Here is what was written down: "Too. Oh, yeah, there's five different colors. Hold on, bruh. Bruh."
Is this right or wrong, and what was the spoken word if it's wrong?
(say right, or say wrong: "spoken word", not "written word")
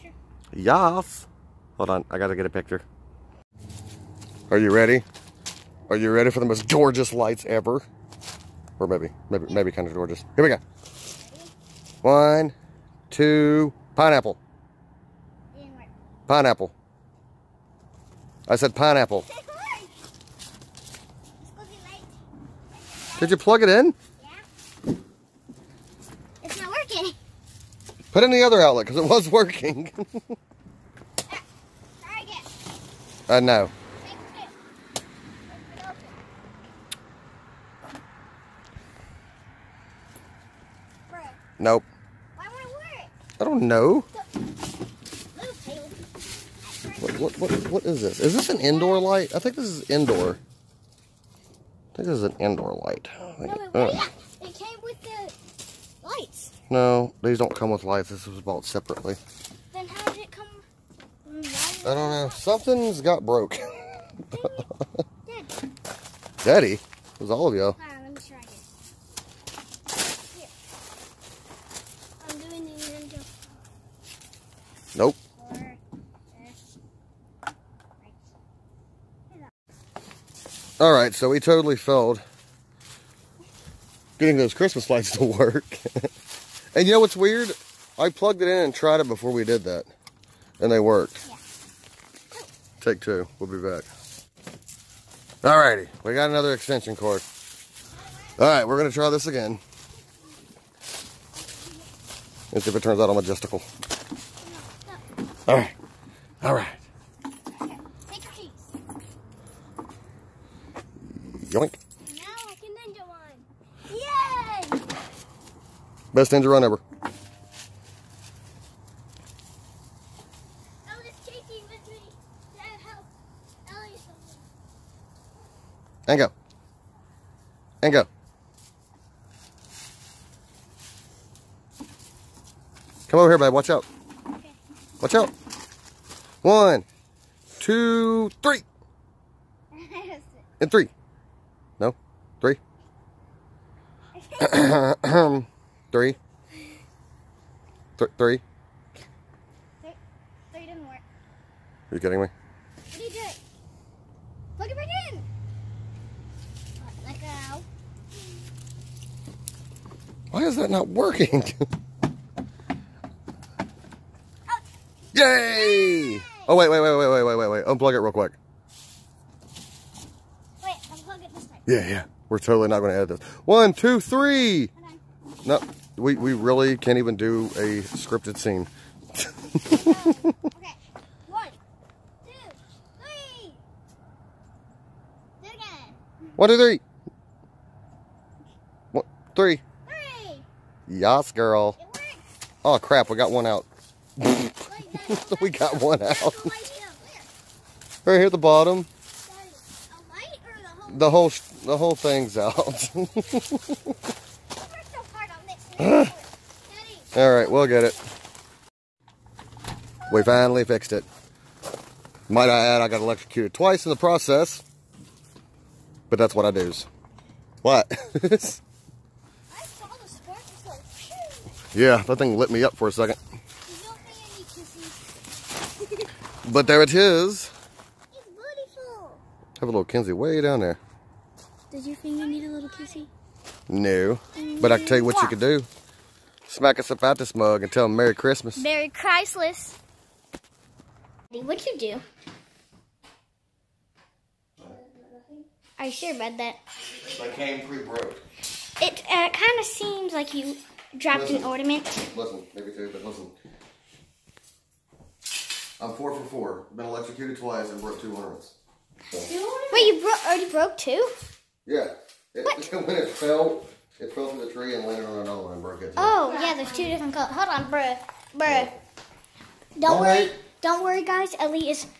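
wrong: "two", not "five".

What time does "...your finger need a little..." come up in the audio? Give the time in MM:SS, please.
03:51.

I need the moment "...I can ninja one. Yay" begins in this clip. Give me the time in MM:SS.
01:52.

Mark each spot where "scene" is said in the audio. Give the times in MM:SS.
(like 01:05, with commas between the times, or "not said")
02:58.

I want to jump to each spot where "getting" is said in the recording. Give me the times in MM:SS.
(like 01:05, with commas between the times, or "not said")
01:24.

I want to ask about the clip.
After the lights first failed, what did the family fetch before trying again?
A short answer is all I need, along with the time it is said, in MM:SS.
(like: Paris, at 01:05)
another extension cord, at 01:36.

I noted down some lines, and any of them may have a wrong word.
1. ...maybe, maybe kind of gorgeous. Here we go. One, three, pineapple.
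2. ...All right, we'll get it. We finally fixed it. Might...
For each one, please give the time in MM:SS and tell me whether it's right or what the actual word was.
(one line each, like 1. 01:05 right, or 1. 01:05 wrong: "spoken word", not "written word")
1. 00:09 wrong: "two", not "three"
2. 03:27 right.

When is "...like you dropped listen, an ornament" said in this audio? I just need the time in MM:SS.
04:10.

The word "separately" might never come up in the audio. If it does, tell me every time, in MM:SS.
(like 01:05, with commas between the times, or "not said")
00:58.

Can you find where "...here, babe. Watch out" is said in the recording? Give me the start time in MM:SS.
02:13.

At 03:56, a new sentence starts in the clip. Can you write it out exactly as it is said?
Smack us up out this mug and tell them Merry Christmas.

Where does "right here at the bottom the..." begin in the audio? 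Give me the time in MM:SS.
03:18.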